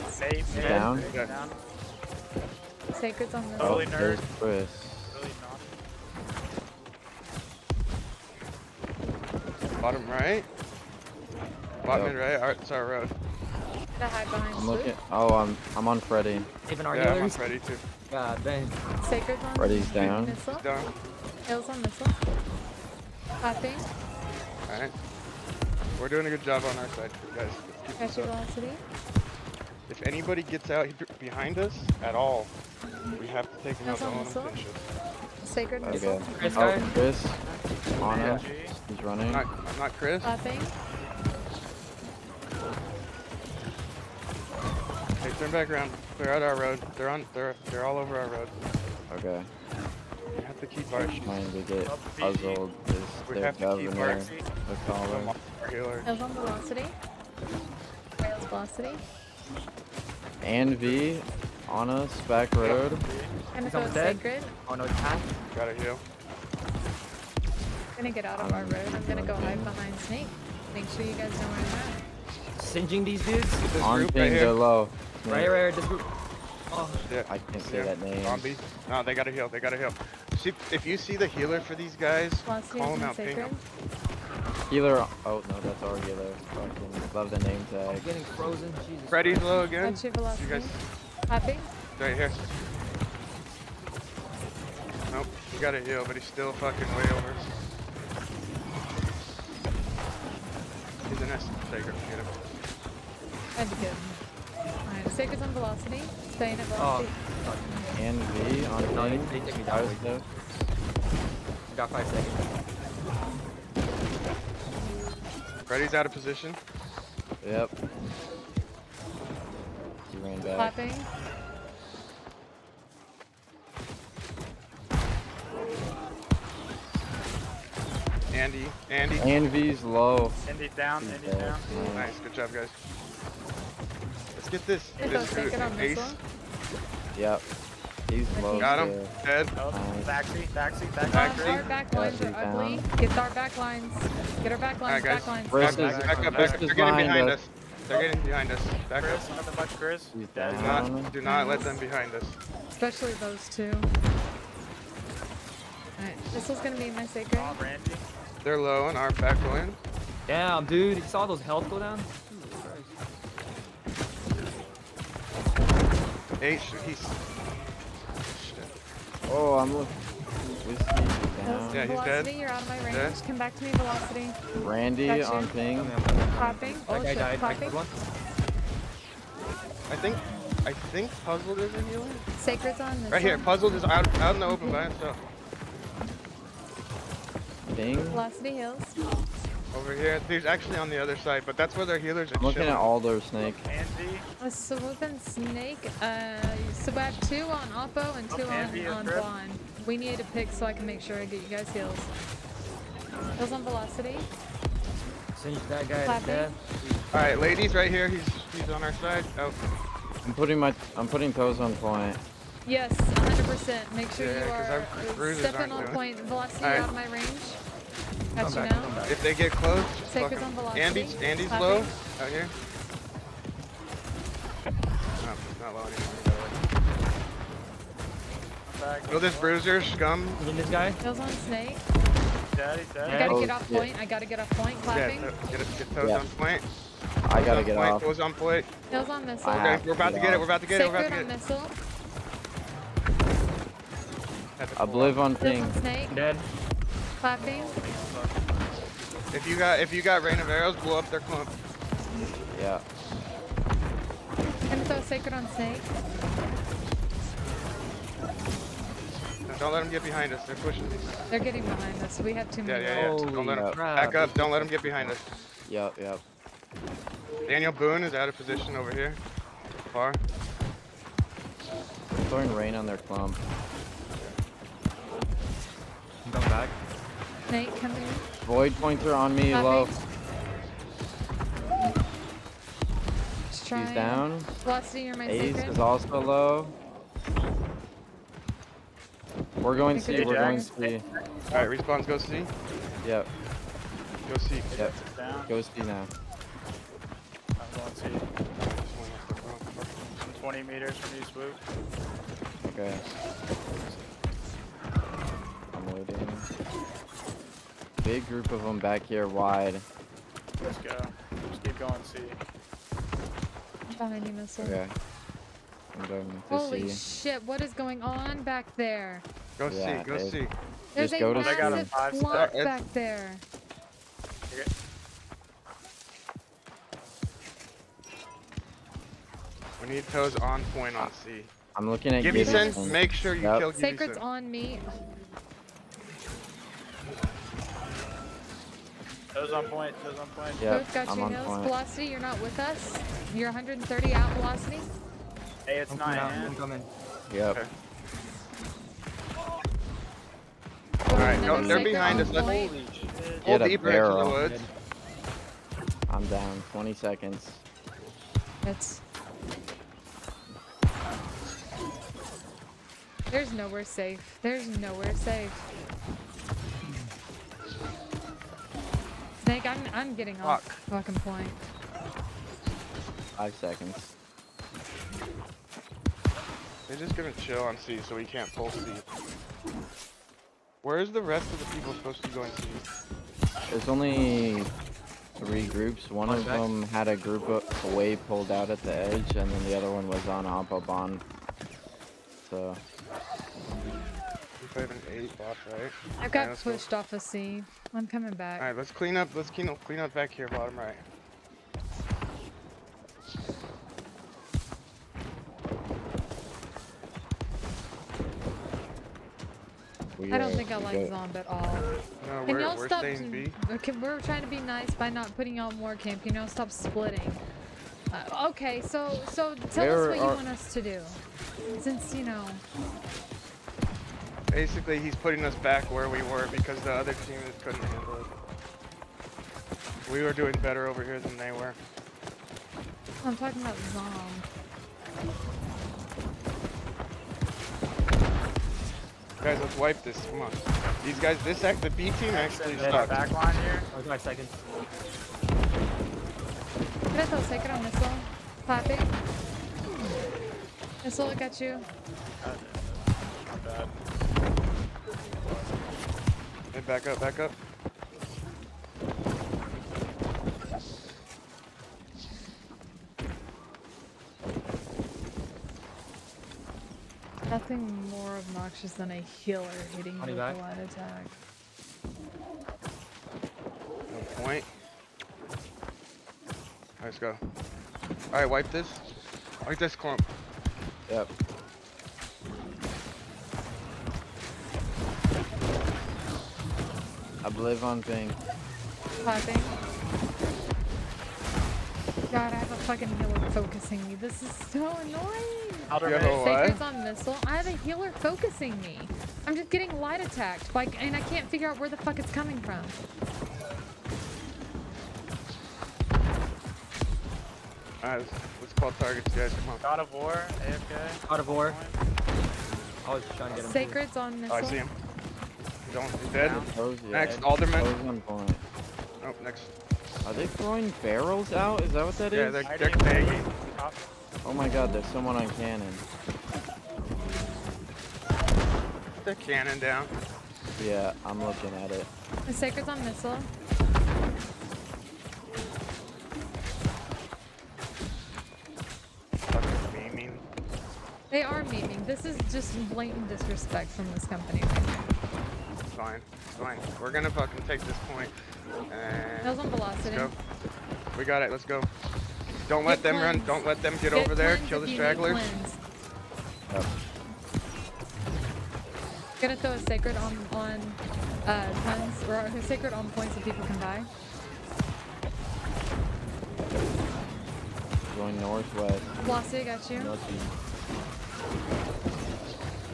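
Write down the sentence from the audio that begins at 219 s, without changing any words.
If they get close, just Sacred fucking...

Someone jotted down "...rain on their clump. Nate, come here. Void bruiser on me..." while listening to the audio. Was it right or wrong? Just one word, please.
wrong.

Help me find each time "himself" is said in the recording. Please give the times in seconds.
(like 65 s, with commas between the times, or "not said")
184 s.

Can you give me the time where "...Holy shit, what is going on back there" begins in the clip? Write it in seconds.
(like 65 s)
316 s.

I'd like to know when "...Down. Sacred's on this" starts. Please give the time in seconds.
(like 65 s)
0 s.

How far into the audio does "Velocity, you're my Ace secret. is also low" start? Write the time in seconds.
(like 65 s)
284 s.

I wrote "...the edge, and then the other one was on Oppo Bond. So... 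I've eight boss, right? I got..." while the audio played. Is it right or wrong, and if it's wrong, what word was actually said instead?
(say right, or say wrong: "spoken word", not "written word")
right.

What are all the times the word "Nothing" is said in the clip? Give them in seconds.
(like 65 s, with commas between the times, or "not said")
149 s, 467 s.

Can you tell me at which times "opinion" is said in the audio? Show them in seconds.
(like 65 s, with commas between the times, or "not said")
not said.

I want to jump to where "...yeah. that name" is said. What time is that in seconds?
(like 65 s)
77 s.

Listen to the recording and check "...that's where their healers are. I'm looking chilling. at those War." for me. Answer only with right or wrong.
wrong.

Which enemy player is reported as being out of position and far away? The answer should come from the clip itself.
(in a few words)
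Daniel Boone.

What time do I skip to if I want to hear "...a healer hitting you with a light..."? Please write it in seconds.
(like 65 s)
469 s.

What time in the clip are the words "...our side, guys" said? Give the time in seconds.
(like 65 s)
26 s.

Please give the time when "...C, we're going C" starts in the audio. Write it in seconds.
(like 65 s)
289 s.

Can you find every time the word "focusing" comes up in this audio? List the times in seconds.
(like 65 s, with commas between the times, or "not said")
493 s, 498 s.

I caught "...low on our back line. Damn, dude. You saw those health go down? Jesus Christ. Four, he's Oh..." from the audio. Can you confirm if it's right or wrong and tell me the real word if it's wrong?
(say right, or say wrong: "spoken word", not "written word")
wrong: "Eight", not "Four".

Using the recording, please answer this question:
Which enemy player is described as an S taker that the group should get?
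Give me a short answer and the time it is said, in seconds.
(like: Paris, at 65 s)
Happy, at 91 s.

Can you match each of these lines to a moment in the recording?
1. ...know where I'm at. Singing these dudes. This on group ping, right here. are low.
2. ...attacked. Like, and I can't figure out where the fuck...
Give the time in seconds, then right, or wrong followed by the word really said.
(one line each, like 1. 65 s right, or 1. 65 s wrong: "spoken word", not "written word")
1. 71 s right
2. 500 s right.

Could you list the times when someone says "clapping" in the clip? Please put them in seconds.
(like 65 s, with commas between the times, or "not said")
40 s, 206 s, 234 s, 247 s, 448 s.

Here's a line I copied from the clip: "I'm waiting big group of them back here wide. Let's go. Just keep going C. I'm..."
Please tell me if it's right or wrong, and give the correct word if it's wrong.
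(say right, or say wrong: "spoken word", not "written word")
right.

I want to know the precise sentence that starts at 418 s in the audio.
Uh, okay, so so tell there us what are...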